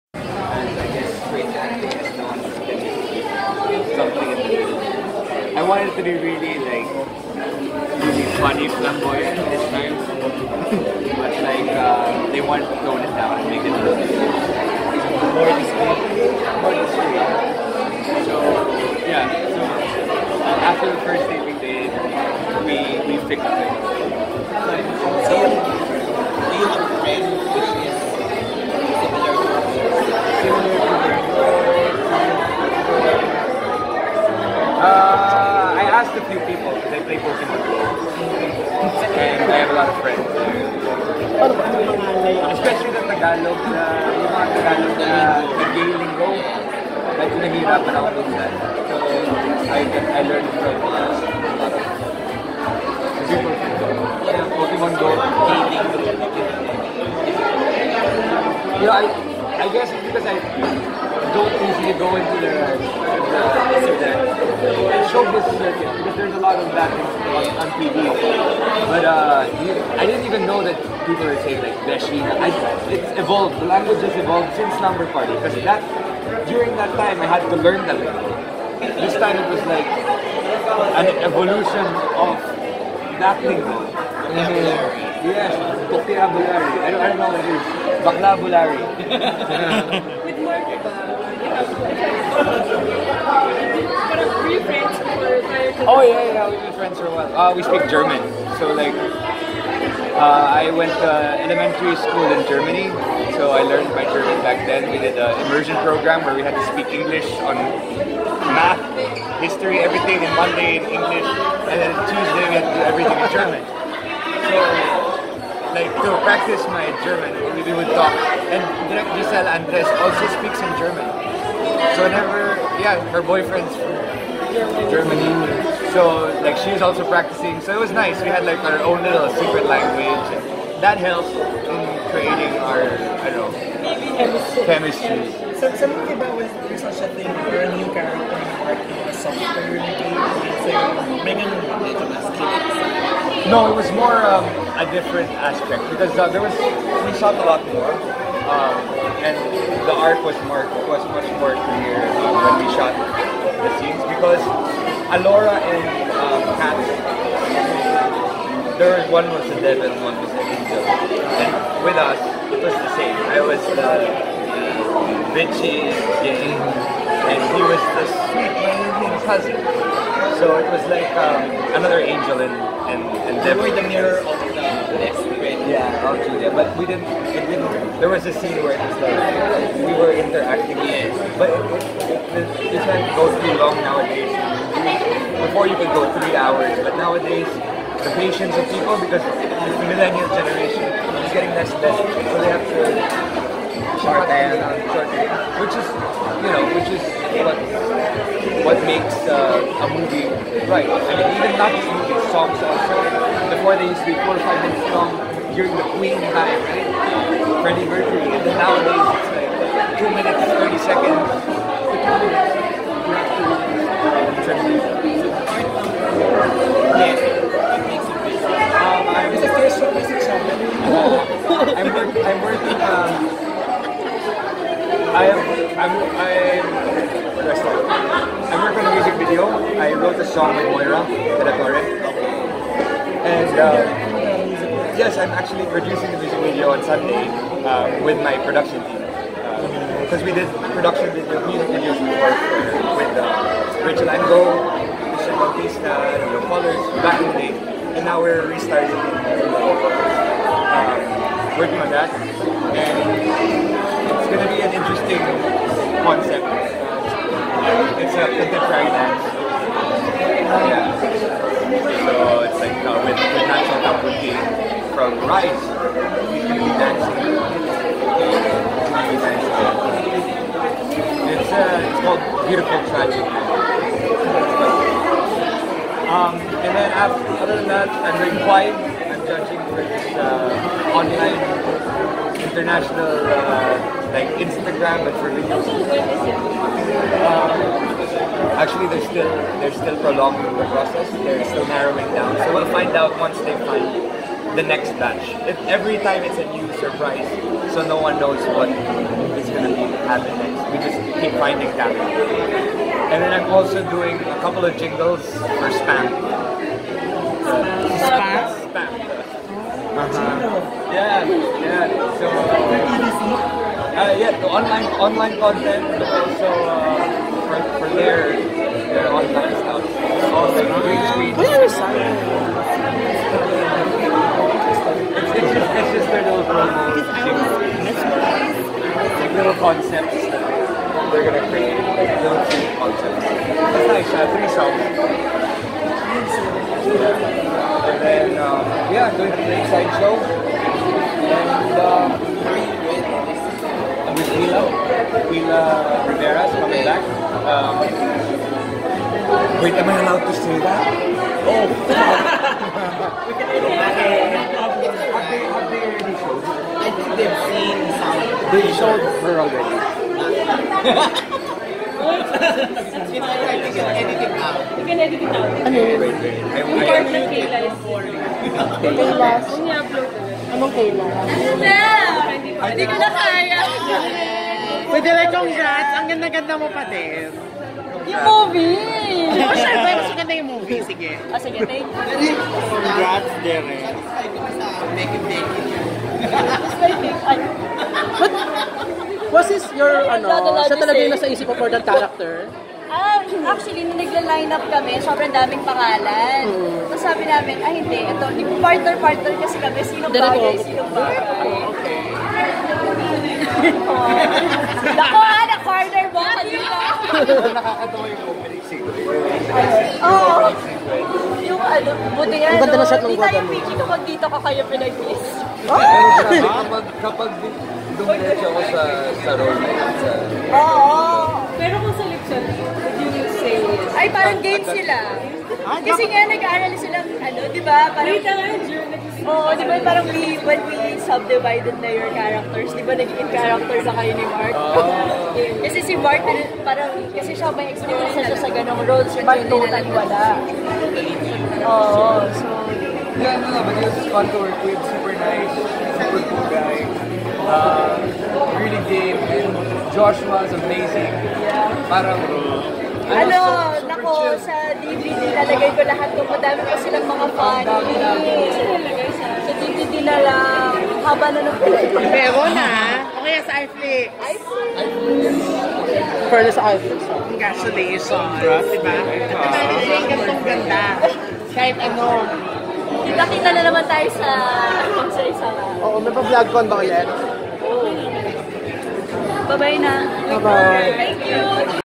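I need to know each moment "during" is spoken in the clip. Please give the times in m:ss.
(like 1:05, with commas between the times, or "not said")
1:16, 3:25.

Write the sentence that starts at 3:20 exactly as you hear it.
I mean, even not just movies, songs also.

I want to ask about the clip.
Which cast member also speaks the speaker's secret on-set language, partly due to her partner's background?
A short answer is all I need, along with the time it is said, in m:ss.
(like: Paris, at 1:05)
Giselle Andres, at 1:59.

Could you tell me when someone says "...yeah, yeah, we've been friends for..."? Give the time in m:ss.
1:36.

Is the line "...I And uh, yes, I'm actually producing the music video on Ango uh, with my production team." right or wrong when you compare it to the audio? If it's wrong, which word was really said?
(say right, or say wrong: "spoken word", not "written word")
wrong: "Sunday", not "Ango".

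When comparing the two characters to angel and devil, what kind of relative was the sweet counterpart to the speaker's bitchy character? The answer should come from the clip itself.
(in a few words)
cousin.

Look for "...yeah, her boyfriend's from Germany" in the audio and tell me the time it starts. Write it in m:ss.
2:02.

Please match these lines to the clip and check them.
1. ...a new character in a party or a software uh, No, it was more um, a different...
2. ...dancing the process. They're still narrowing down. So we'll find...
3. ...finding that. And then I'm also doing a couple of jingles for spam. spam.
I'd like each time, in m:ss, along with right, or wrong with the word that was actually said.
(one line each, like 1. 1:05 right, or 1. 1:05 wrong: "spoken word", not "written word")
1. 2:17 right
2. 4:50 wrong: "prolonging", not "dancing"
3. 5:01 right.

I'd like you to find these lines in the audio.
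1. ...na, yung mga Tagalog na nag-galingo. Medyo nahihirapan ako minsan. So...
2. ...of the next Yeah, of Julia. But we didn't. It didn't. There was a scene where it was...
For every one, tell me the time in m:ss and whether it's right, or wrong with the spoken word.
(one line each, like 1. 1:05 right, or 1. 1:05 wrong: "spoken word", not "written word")
1. 0:43 right
2. 2:54 right.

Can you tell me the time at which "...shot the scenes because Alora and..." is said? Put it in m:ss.
2:32.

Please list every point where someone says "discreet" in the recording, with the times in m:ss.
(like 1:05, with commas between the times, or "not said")
0:15.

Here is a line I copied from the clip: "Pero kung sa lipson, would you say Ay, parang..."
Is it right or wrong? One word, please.
right.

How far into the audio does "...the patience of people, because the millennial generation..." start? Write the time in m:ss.
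3:08.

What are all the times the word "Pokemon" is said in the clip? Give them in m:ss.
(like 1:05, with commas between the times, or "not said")
0:37, 0:54.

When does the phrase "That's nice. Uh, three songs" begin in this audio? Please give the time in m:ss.
5:33.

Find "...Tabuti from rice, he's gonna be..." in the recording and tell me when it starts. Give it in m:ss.
4:23.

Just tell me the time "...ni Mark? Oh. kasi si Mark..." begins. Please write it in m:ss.
7:14.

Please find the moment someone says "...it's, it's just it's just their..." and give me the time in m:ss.
5:21.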